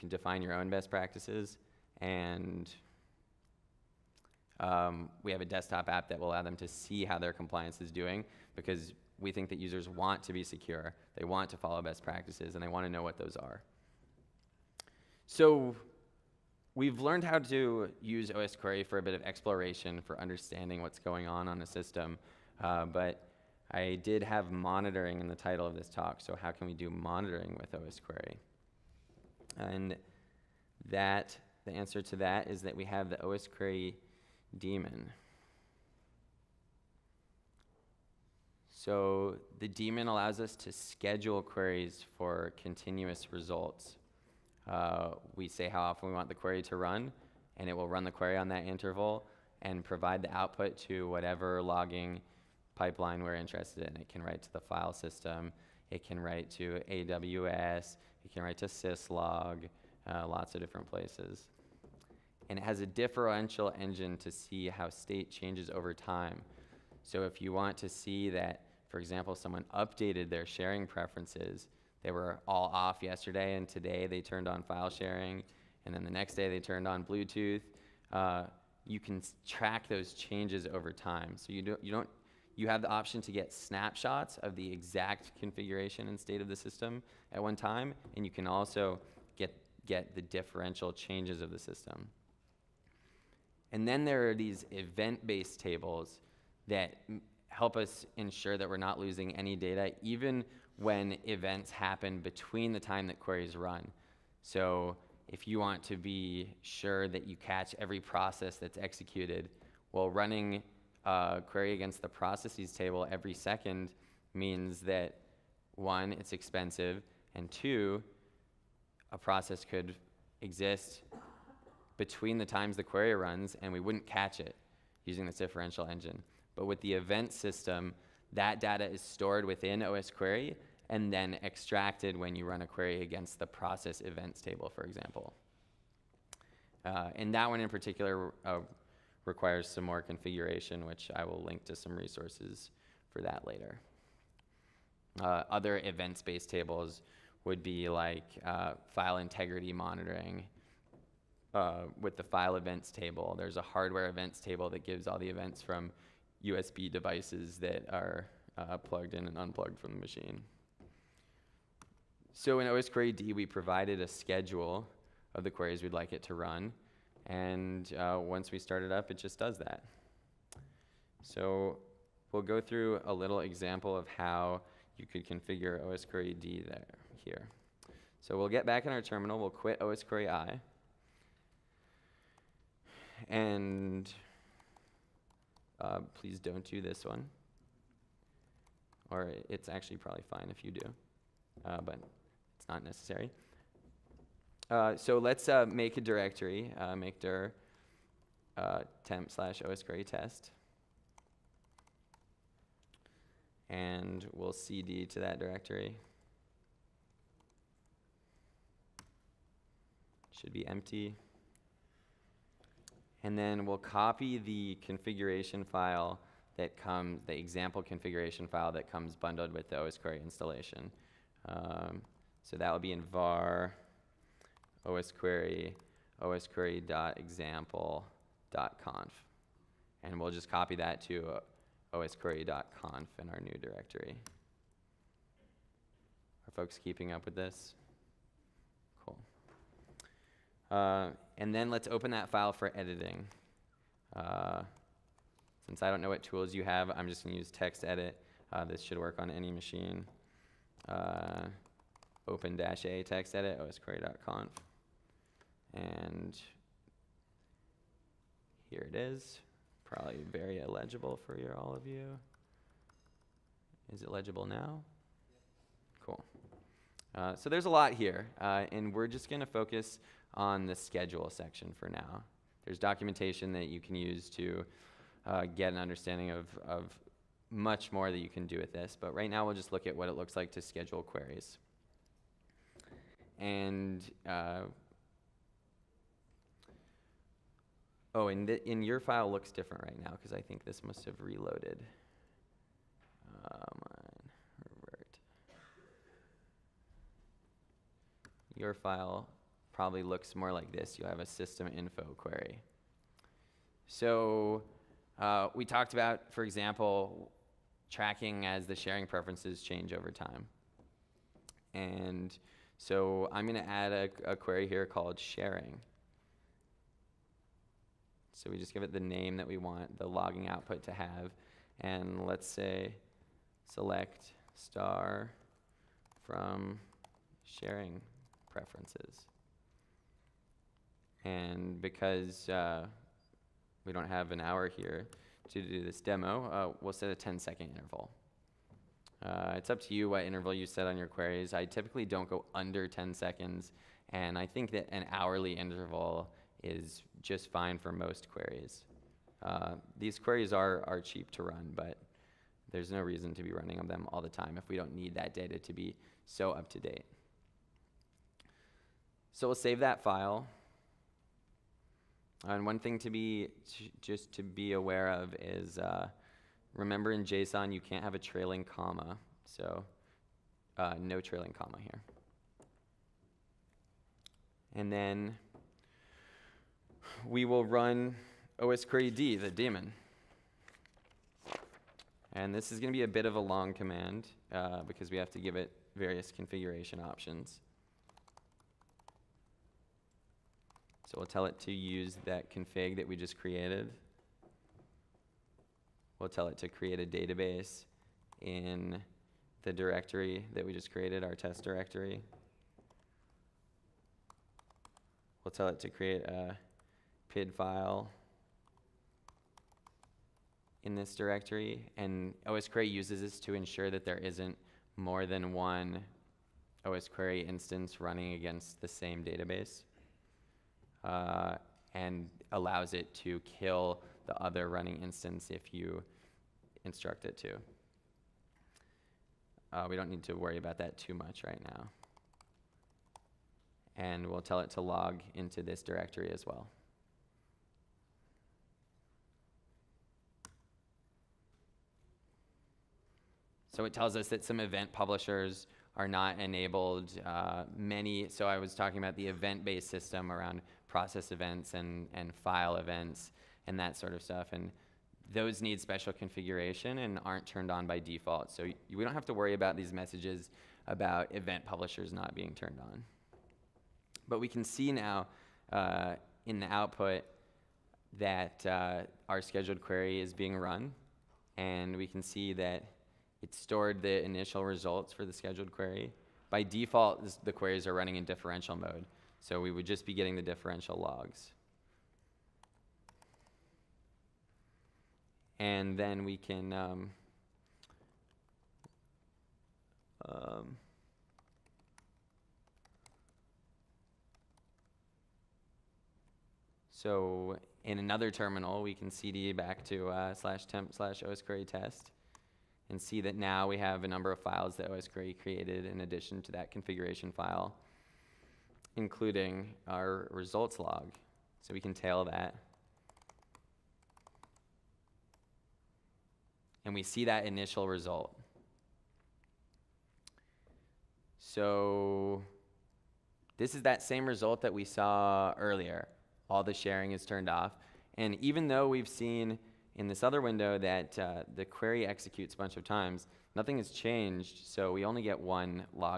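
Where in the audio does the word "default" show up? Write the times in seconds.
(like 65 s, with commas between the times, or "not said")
457 s, 476 s.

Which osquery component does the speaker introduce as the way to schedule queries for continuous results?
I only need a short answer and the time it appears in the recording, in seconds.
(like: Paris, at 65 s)
osquery daemon, at 33 s.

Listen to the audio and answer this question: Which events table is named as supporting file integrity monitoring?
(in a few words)
file events table.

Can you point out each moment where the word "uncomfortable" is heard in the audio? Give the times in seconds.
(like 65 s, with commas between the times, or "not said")
not said.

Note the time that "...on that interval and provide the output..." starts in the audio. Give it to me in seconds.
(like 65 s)
48 s.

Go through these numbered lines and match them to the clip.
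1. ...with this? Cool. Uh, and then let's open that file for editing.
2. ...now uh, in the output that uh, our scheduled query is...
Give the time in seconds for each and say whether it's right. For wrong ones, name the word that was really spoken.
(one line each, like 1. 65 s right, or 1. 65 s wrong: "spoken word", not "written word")
1. 237 s right
2. 464 s right.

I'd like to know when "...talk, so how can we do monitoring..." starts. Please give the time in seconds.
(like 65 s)
25 s.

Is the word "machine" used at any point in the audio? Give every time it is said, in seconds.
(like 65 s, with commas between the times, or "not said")
159 s, 249 s.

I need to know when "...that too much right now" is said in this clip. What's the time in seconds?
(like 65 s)
430 s.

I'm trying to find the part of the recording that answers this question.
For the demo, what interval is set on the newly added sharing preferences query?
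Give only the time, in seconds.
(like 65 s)
337 s.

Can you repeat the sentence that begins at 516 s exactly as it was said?
And we see that initial result.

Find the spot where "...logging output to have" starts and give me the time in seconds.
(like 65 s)
320 s.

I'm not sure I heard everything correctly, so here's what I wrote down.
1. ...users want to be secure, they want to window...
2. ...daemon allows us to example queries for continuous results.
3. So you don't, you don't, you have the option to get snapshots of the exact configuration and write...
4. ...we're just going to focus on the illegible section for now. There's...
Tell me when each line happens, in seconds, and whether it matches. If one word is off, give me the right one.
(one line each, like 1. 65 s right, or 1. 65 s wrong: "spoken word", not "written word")
1. 9 s wrong: "follow", not "window"
2. 39 s wrong: "schedule", not "example"
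3. 81 s wrong: "state", not "write"
4. 268 s wrong: "schedule", not "illegible".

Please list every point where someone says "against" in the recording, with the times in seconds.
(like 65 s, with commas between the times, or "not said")
111 s, 133 s, 418 s.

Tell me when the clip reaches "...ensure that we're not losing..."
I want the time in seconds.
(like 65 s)
98 s.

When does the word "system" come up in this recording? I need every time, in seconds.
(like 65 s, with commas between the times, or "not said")
21 s, 54 s, 86 s, 91 s, 127 s, 301 s, 449 s.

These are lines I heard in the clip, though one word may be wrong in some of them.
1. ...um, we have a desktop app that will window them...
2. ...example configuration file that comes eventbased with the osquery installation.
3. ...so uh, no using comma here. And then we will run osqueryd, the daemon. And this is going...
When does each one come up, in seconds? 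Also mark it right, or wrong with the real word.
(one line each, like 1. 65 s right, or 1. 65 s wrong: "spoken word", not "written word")
1. 4 s wrong: "allow", not "window"
2. 217 s wrong: "bundled", not "eventbased"
3. 369 s wrong: "trailing", not "using".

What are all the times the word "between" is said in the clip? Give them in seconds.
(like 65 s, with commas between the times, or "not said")
102 s, 121 s.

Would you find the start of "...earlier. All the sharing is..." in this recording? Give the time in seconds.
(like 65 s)
525 s.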